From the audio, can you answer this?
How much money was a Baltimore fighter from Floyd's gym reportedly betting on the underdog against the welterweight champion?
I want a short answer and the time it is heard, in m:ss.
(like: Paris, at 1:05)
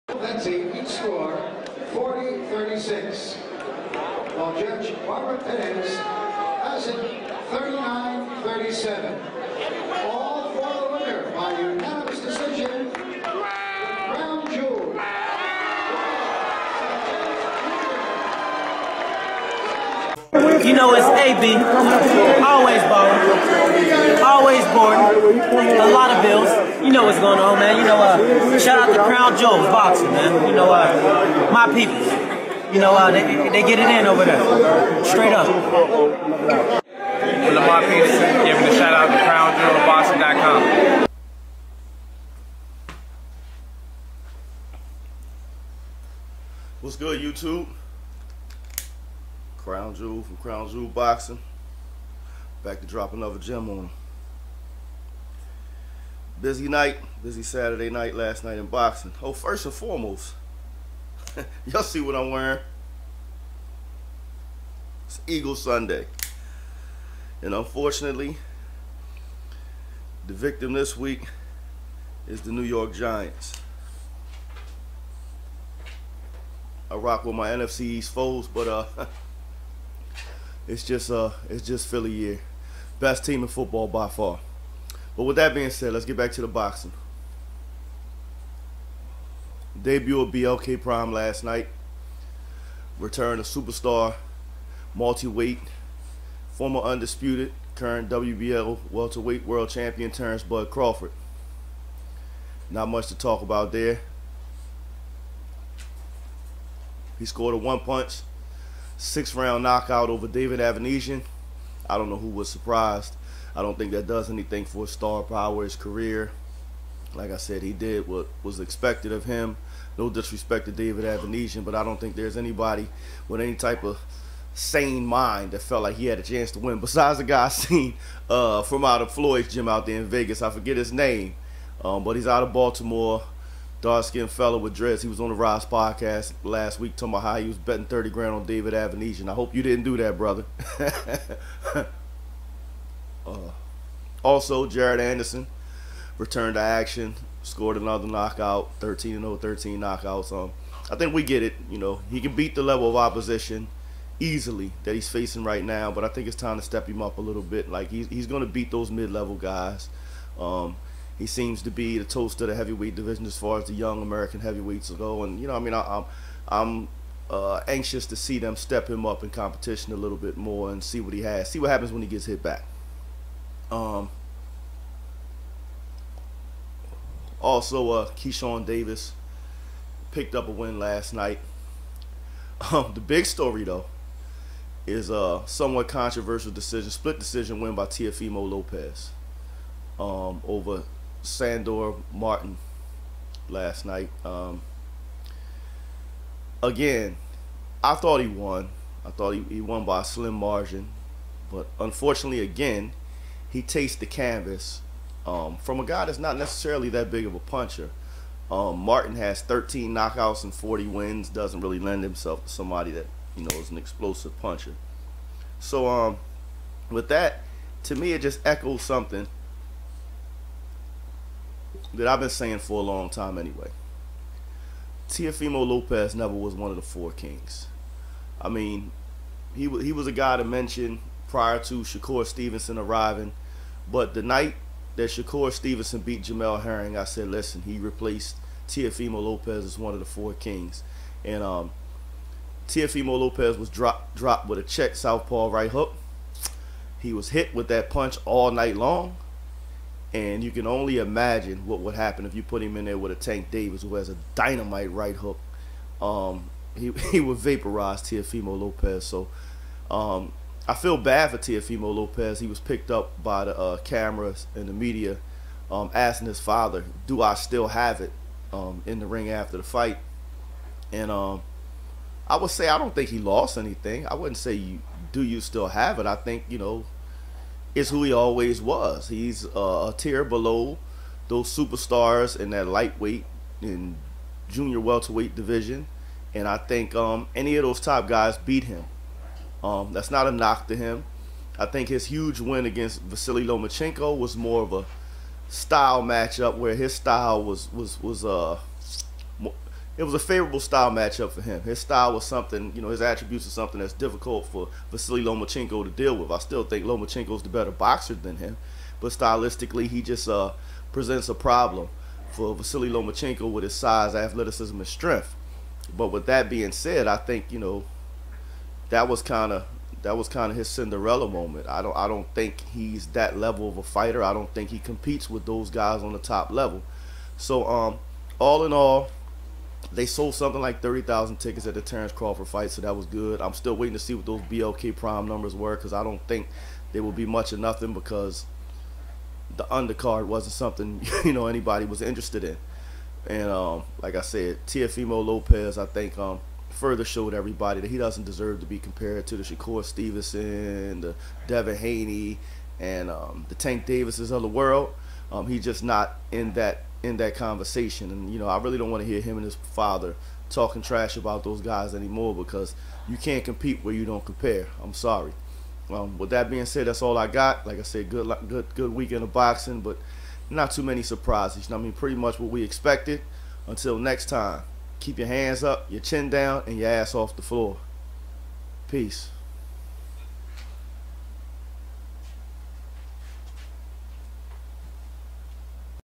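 30 grand, at 2:17.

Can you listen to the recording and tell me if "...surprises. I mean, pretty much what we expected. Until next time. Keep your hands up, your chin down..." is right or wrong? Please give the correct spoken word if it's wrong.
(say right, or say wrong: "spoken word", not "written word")
right.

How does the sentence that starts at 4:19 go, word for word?
So um, I feel bad for Teofimo Lopez.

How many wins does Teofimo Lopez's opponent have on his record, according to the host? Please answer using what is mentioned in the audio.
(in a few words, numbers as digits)
40.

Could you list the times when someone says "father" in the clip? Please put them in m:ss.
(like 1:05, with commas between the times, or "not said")
4:26, 5:59.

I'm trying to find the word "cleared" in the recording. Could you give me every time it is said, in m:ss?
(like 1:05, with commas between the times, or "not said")
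not said.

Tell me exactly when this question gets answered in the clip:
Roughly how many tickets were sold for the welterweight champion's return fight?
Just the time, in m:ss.
5:30.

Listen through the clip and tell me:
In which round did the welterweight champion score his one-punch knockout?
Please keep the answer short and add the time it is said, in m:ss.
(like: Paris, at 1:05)
6, at 1:48.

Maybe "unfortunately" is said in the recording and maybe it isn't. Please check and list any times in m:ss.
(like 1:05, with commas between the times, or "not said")
1:07, 3:21.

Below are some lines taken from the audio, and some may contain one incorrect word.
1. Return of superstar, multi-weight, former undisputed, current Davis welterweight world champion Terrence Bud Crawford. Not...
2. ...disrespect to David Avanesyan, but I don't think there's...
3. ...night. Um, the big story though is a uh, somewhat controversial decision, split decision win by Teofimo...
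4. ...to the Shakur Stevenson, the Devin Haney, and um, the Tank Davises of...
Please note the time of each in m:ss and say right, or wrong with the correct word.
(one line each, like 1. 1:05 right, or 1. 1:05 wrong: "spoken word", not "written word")
1. 1:32 wrong: "WBO", not "Davis"
2. 2:00 right
3. 3:01 right
4. 5:49 right.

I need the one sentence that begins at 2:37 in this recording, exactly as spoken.
Like he's he's going to beat those mid-level guys.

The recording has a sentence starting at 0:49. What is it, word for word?
Crown Jewel from Crown Jewel Boxing.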